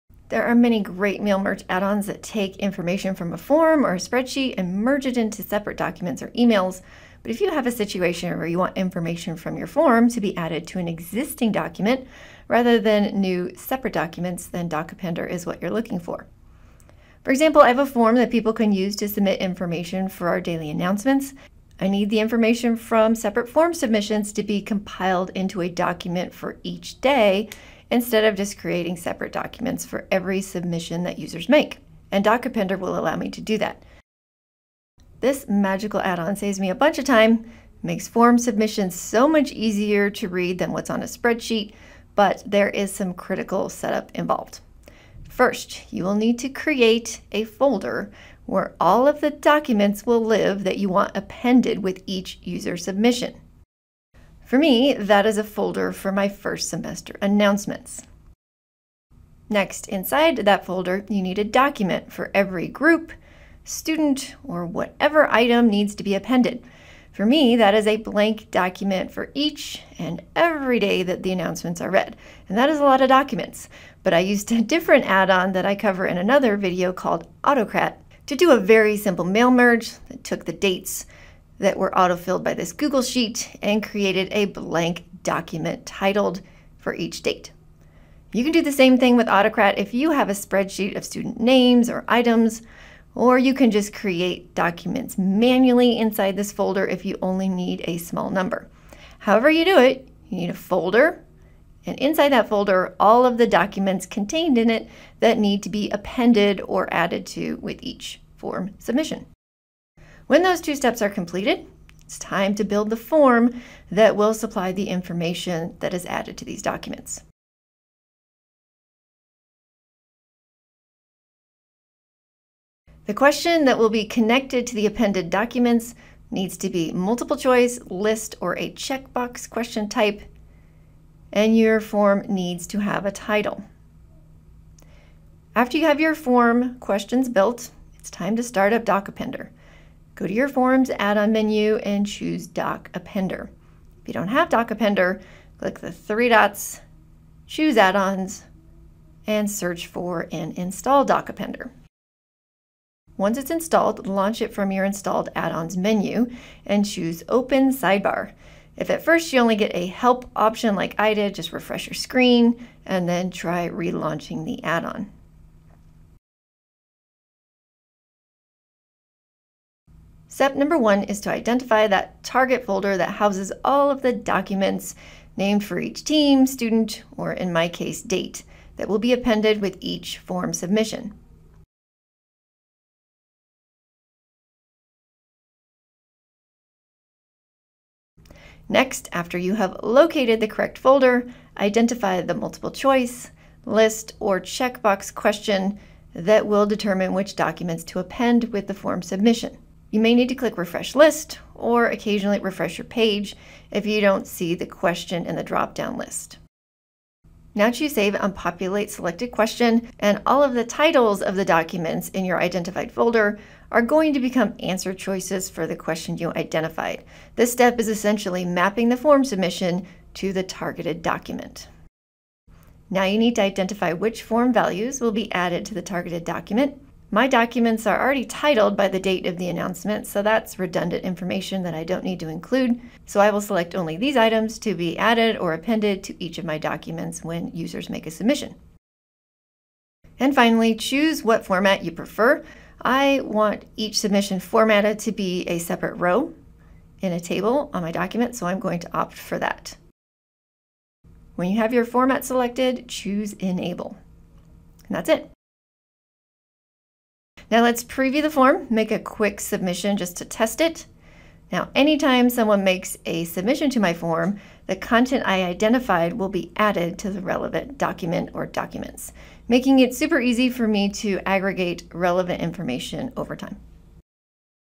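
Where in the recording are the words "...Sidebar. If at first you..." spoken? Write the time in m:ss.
2:37.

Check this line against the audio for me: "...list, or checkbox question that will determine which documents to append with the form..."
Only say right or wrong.
right.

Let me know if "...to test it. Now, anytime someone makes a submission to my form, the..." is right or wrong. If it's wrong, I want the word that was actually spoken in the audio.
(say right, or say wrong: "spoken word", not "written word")
right.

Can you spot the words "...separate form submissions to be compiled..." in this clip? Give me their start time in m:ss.
0:23.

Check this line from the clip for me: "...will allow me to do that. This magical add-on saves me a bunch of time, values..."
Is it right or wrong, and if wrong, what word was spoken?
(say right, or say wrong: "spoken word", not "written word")
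wrong: "makes", not "values".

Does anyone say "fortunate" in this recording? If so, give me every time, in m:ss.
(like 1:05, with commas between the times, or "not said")
not said.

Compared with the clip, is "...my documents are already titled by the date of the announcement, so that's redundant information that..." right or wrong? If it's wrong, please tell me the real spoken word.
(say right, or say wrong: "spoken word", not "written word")
right.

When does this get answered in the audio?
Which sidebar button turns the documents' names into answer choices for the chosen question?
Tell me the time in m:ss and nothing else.
3:27.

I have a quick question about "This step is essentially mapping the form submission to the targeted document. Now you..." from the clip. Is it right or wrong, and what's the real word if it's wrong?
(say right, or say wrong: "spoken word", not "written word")
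right.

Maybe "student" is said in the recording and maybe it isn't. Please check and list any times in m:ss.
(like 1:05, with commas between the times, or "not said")
1:03, 1:31, 2:56.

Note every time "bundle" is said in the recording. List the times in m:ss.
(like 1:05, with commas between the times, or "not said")
not said.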